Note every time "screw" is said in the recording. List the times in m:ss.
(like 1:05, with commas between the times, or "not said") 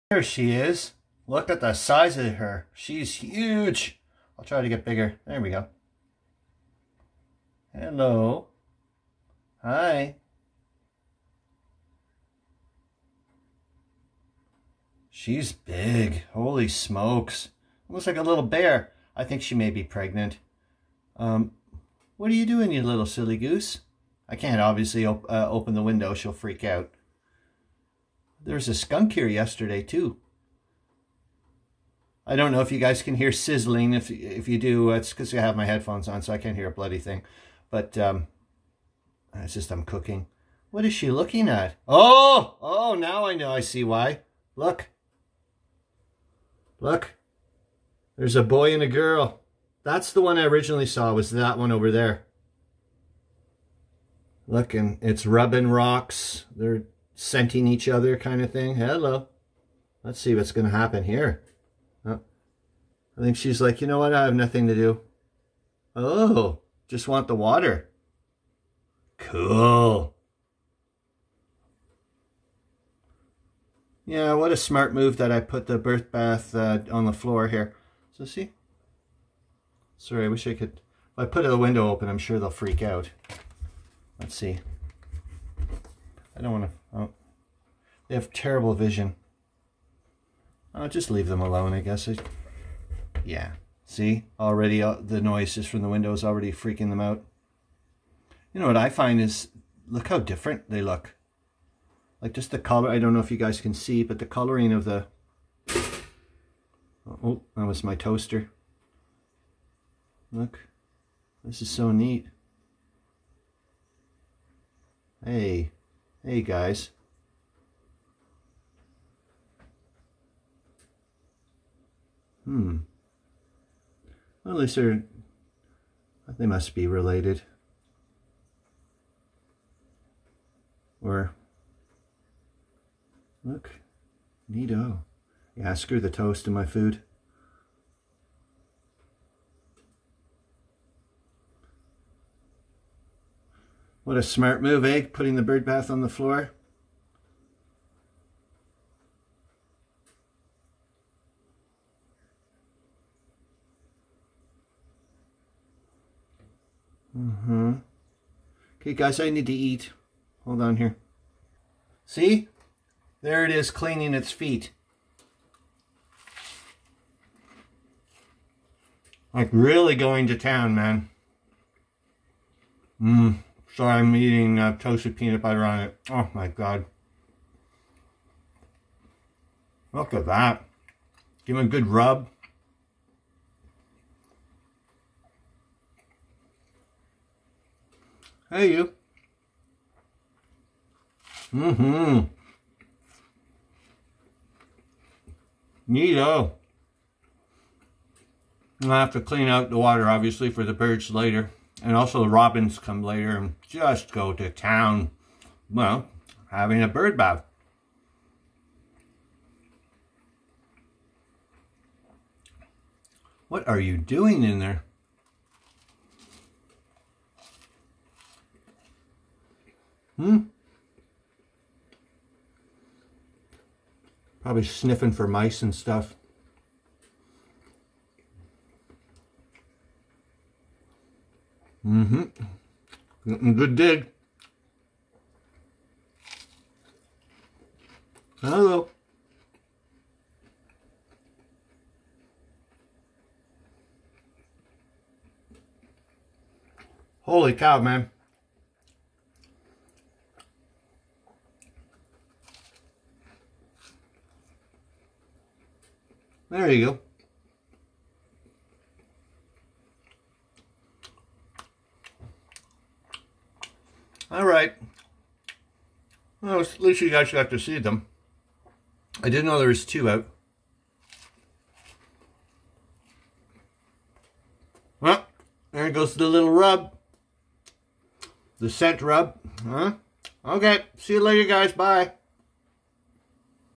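2:15.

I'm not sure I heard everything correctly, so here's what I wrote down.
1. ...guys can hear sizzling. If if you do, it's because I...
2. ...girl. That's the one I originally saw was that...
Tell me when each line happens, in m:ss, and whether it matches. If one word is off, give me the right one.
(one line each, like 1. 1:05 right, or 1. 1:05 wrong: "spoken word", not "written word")
1. 0:32 right
2. 0:48 right.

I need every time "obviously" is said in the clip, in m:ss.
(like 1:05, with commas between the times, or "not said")
0:24, 3:20.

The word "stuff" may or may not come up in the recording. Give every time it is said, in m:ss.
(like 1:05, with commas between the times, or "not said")
3:45.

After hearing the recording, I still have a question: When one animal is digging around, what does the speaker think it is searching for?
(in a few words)
Mice.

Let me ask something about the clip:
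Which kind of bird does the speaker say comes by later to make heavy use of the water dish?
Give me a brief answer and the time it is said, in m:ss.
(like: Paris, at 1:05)
Robins, at 3:22.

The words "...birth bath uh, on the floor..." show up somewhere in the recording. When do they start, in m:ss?
1:15.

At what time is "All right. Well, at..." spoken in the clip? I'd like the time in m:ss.
4:24.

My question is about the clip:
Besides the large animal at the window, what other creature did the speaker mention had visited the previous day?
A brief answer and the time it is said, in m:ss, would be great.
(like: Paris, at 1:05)
Skunk, at 0:28.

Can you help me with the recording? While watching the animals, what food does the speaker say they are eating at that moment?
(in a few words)
Toasted peanut butter.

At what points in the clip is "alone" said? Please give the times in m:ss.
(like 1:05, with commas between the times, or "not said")
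1:31.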